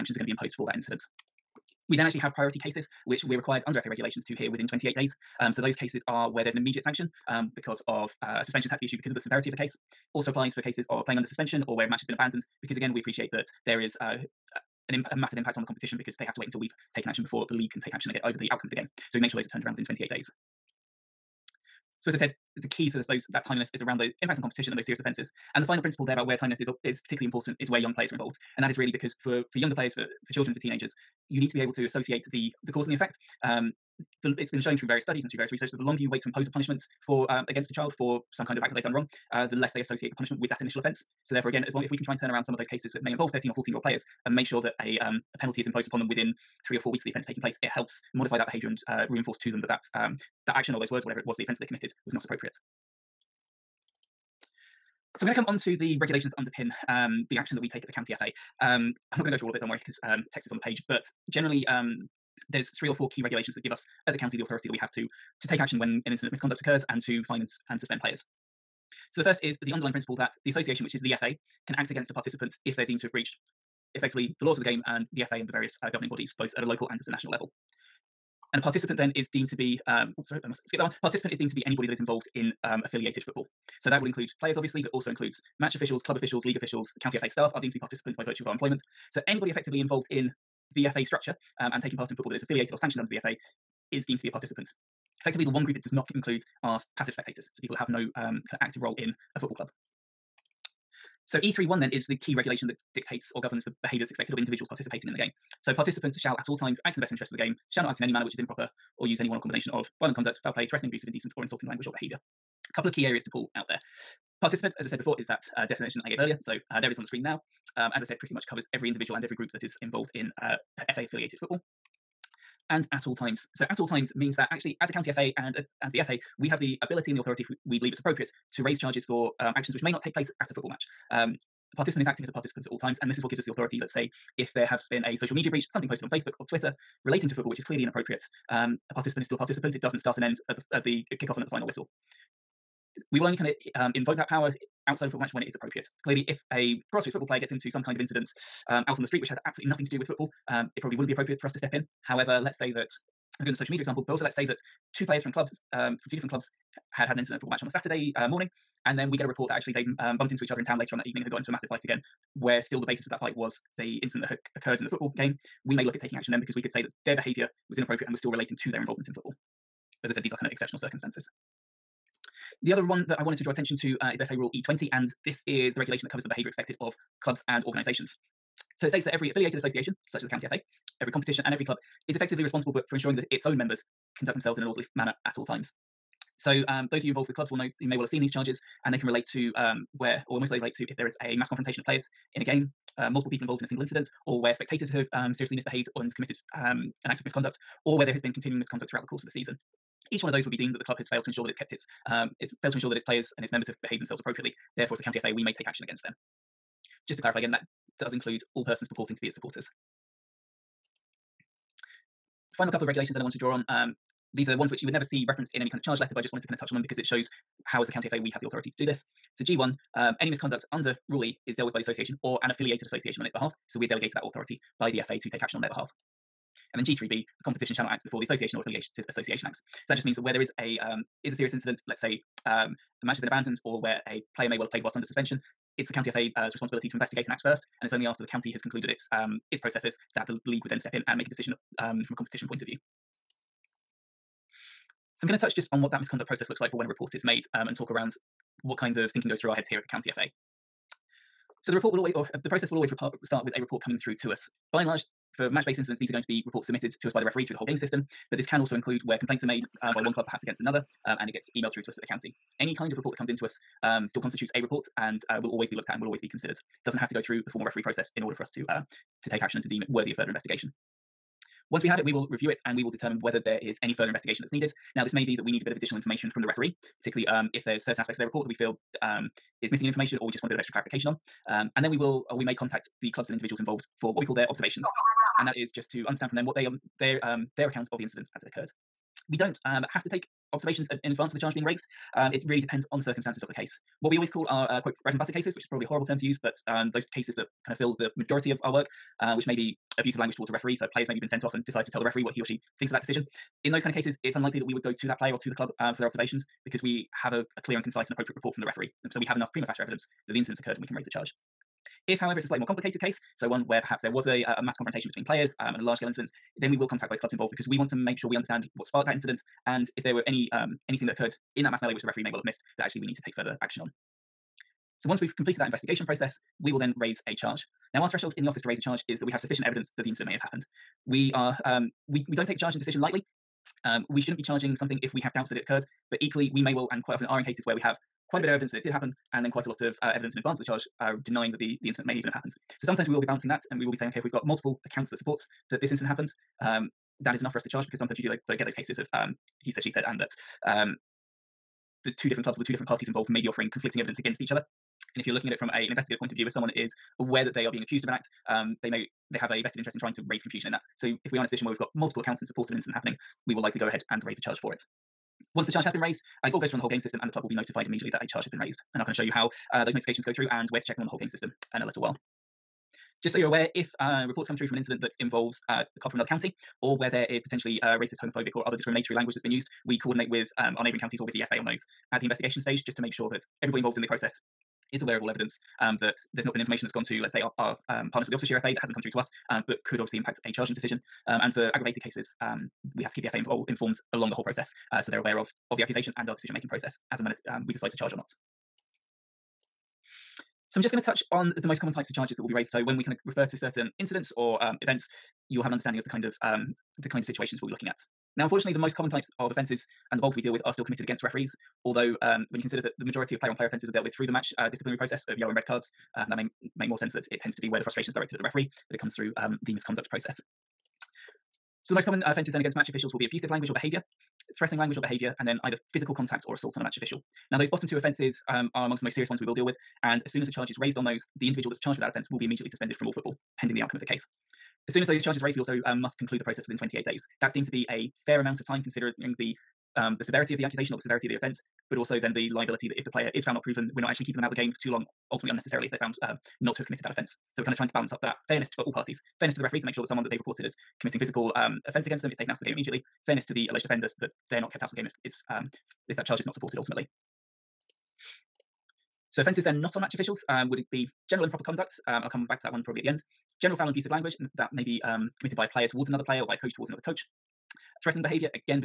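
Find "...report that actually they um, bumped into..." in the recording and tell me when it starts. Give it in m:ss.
2:39.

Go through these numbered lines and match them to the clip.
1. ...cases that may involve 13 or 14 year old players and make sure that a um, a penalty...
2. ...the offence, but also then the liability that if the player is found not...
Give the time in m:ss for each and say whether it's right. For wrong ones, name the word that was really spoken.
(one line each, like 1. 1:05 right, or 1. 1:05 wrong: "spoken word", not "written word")
1. 0:42 right
2. 7:21 right.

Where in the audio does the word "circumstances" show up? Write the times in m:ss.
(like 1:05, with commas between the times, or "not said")
2:50, 4:53.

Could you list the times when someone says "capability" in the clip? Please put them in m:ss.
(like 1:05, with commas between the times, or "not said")
not said.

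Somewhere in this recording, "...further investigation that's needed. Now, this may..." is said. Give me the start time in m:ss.
4:33.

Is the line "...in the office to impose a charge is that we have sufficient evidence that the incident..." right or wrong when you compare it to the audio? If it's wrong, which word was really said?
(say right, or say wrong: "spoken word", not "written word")
wrong: "raise", not "impose".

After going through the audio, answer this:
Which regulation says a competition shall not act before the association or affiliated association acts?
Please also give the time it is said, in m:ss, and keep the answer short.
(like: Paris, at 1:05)
G3B, at 3:46.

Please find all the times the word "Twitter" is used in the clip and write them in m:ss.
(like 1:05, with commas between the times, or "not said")
2:16.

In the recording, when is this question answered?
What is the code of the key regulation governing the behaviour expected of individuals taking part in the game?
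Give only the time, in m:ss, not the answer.
1:41.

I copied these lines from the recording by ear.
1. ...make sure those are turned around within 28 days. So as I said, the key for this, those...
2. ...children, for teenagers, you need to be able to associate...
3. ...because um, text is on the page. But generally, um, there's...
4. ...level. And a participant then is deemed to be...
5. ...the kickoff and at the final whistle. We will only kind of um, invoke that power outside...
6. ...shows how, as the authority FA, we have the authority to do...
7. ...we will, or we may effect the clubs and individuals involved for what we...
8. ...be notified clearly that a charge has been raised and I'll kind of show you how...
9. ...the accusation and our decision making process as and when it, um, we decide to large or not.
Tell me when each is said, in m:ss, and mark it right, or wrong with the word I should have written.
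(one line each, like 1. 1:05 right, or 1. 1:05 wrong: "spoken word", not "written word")
1. 0:19 right
2. 0:30 right
3. 0:59 right
4. 1:17 right
5. 2:20 right
6. 3:37 wrong: "county", not "authority"
7. 4:41 wrong: "contact", not "effect"
8. 6:07 wrong: "immediately", not "clearly"
9. 6:35 wrong: "charge", not "large".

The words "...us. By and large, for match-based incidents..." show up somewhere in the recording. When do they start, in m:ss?
4:14.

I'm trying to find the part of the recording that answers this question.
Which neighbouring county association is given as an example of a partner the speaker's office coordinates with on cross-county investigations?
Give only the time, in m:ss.
6:28.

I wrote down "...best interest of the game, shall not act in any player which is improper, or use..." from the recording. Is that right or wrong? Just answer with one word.
wrong.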